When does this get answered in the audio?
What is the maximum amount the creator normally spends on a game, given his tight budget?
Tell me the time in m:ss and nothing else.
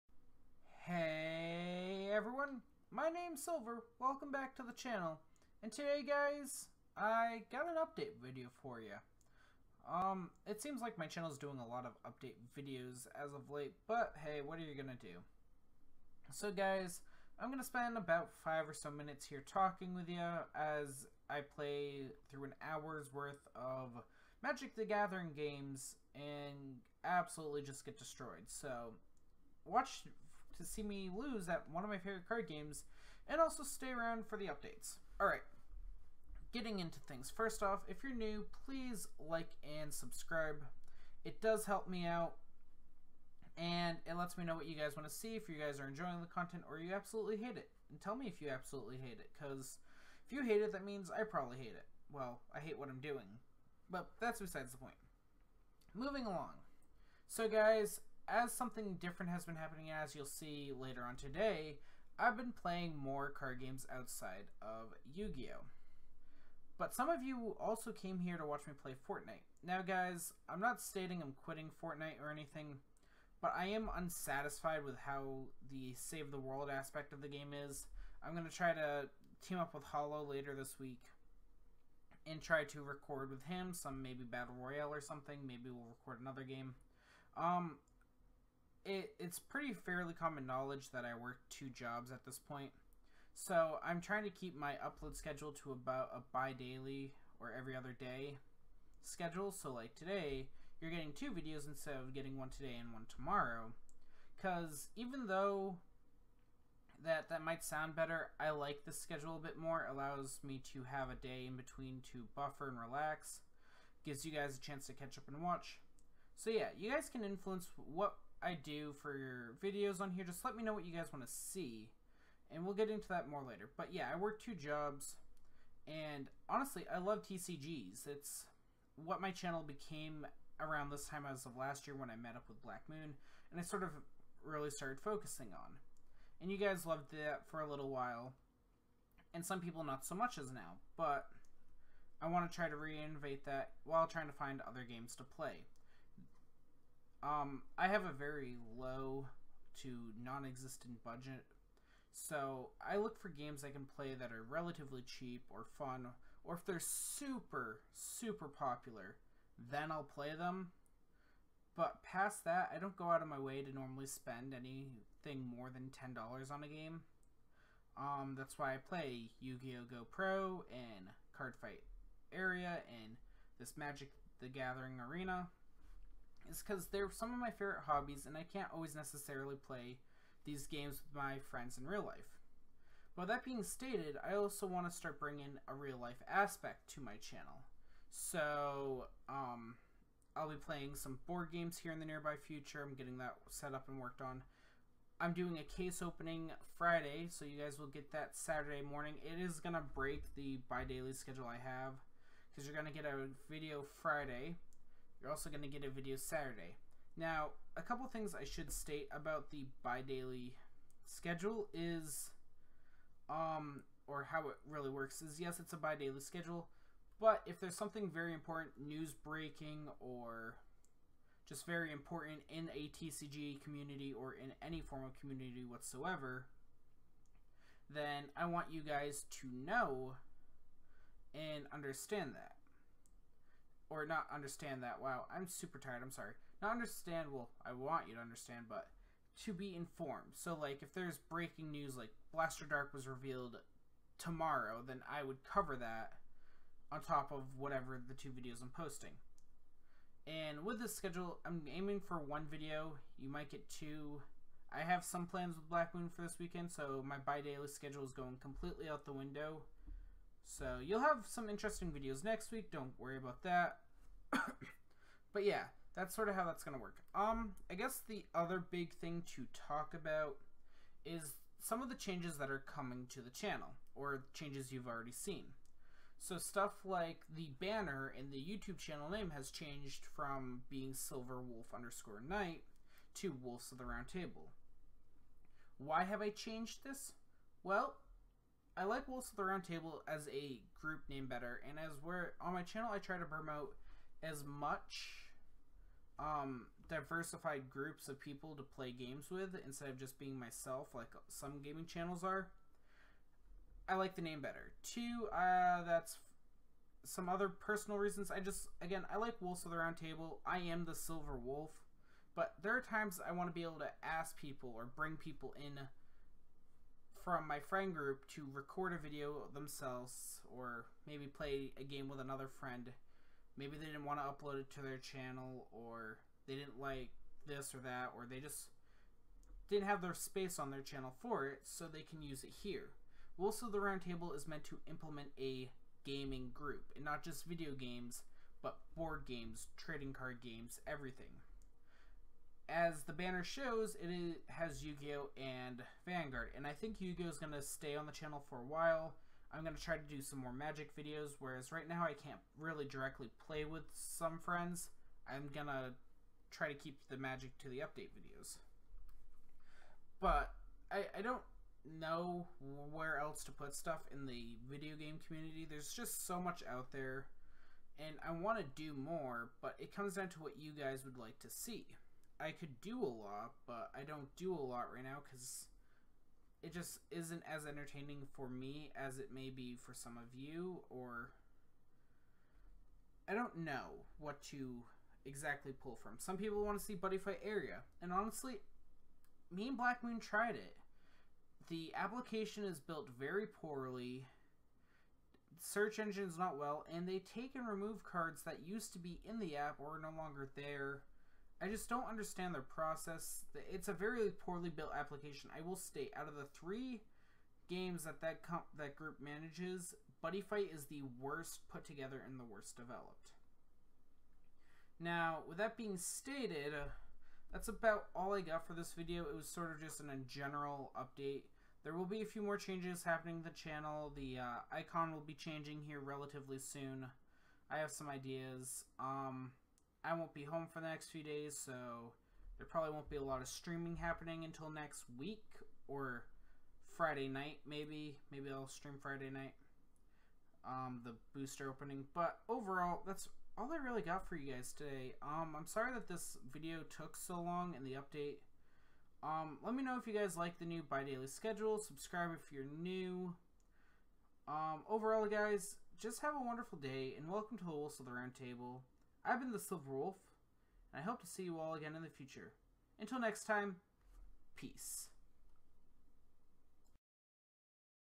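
2:45.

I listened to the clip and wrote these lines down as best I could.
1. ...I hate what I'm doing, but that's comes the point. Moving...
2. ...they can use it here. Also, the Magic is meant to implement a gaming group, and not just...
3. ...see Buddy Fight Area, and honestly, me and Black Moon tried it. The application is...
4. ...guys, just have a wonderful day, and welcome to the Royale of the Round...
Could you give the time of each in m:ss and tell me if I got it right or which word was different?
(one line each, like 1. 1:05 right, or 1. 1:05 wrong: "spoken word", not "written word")
1. 0:52 wrong: "besides", not "comes"
2. 5:31 wrong: "Roundtable", not "Magic"
3. 6:26 right
4. 7:35 wrong: "Wolves", not "Royale".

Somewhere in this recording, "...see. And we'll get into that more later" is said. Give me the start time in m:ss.
2:01.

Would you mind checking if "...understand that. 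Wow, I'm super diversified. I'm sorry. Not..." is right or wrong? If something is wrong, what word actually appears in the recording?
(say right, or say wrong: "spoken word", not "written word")
wrong: "tired", not "diversified".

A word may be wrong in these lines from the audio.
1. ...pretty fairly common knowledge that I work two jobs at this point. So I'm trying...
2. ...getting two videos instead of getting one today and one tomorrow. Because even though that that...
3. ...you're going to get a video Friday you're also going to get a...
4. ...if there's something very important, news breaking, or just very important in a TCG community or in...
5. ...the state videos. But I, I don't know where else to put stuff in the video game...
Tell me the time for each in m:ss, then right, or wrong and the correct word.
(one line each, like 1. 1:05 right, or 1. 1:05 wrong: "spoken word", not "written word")
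1. 1:29 right
2. 1:40 right
3. 3:22 right
4. 3:37 right
5. 5:57 wrong: "update", not "state".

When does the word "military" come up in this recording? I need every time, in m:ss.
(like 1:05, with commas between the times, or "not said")
not said.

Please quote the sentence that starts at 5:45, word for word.
and Vanguard, and I think Yu-Gi-Oh!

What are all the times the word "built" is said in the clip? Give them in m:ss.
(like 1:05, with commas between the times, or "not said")
6:32, 6:44.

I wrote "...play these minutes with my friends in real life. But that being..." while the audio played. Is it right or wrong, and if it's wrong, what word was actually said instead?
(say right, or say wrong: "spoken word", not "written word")
wrong: "games", not "minutes".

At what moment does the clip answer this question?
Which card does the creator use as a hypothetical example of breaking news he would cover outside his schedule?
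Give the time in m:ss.
4:02.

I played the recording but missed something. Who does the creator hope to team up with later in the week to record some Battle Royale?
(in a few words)
Hollow.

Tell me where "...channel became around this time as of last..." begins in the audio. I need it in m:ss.
2:09.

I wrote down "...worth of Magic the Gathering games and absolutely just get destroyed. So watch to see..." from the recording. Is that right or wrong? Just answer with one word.
right.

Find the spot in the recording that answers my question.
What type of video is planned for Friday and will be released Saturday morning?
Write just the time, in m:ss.
3:15.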